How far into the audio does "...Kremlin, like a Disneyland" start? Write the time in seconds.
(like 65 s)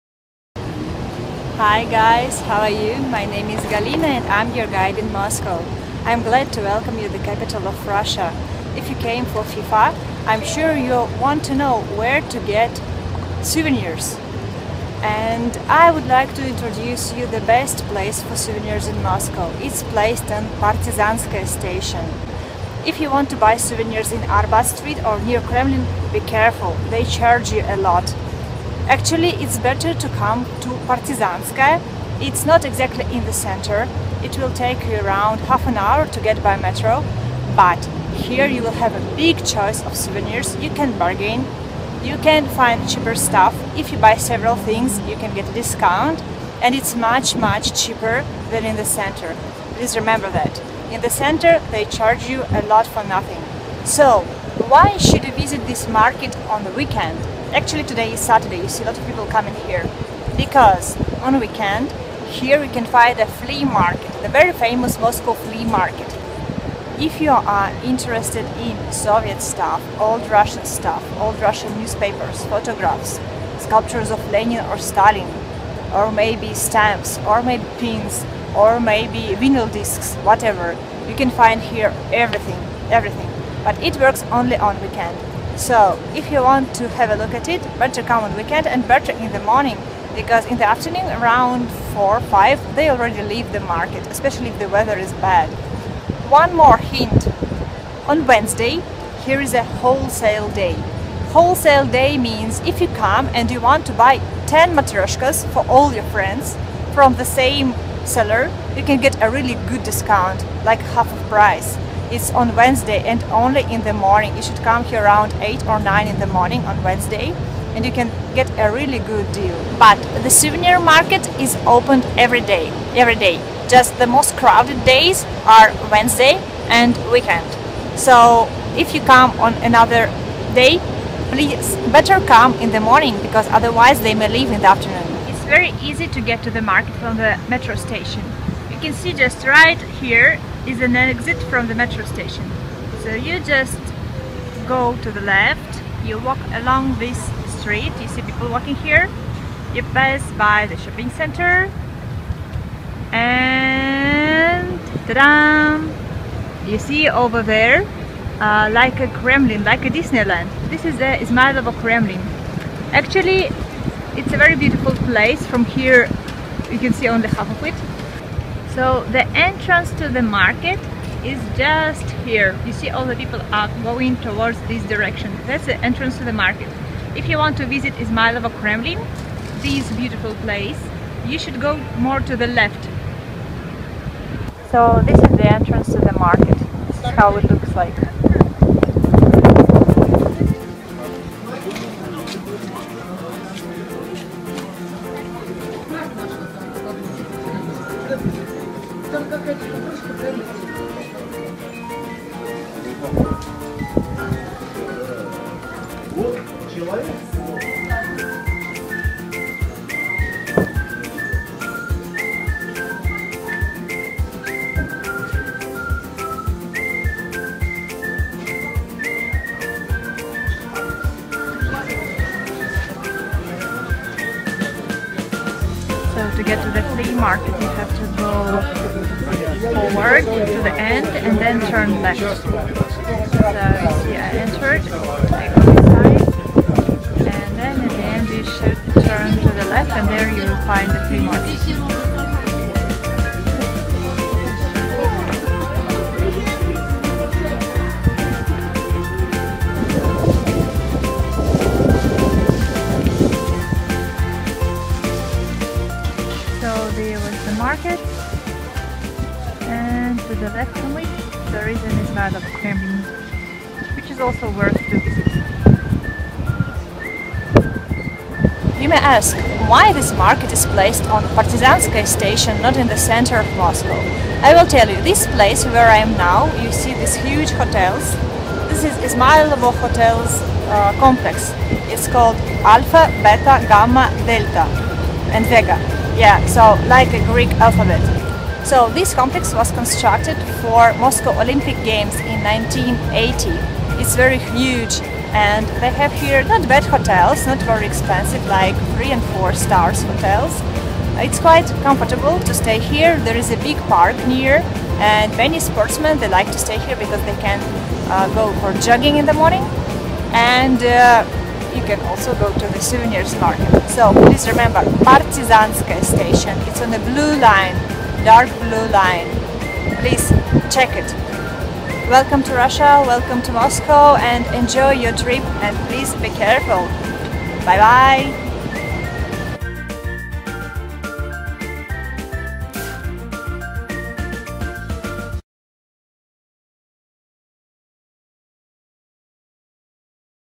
159 s.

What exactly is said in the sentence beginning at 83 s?
But it works only on weekend.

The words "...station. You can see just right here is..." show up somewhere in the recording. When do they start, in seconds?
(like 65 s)
137 s.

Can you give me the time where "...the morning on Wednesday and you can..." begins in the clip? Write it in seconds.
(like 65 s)
116 s.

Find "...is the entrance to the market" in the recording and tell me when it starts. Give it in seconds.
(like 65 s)
185 s.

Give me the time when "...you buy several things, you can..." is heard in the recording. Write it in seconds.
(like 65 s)
43 s.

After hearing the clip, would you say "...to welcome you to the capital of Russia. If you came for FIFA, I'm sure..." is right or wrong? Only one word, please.
right.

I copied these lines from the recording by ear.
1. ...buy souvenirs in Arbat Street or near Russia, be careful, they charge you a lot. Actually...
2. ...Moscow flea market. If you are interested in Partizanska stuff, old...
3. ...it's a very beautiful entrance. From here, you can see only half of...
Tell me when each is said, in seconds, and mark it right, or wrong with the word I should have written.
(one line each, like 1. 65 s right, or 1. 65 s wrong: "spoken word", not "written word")
1. 23 s wrong: "Kremlin", not "Russia"
2. 64 s wrong: "Soviet", not "Partizanska"
3. 164 s wrong: "place", not "entrance".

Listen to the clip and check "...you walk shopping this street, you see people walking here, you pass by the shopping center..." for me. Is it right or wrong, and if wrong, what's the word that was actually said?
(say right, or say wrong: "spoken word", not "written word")
wrong: "along", not "shopping".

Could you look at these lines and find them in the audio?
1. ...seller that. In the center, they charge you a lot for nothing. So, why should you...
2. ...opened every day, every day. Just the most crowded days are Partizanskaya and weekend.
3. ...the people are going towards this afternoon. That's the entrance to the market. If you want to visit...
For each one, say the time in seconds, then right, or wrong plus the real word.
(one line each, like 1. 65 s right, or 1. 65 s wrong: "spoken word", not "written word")
1. 49 s wrong: "remember", not "seller"
2. 121 s wrong: "Wednesday", not "Partizanskaya"
3. 173 s wrong: "direction", not "afternoon".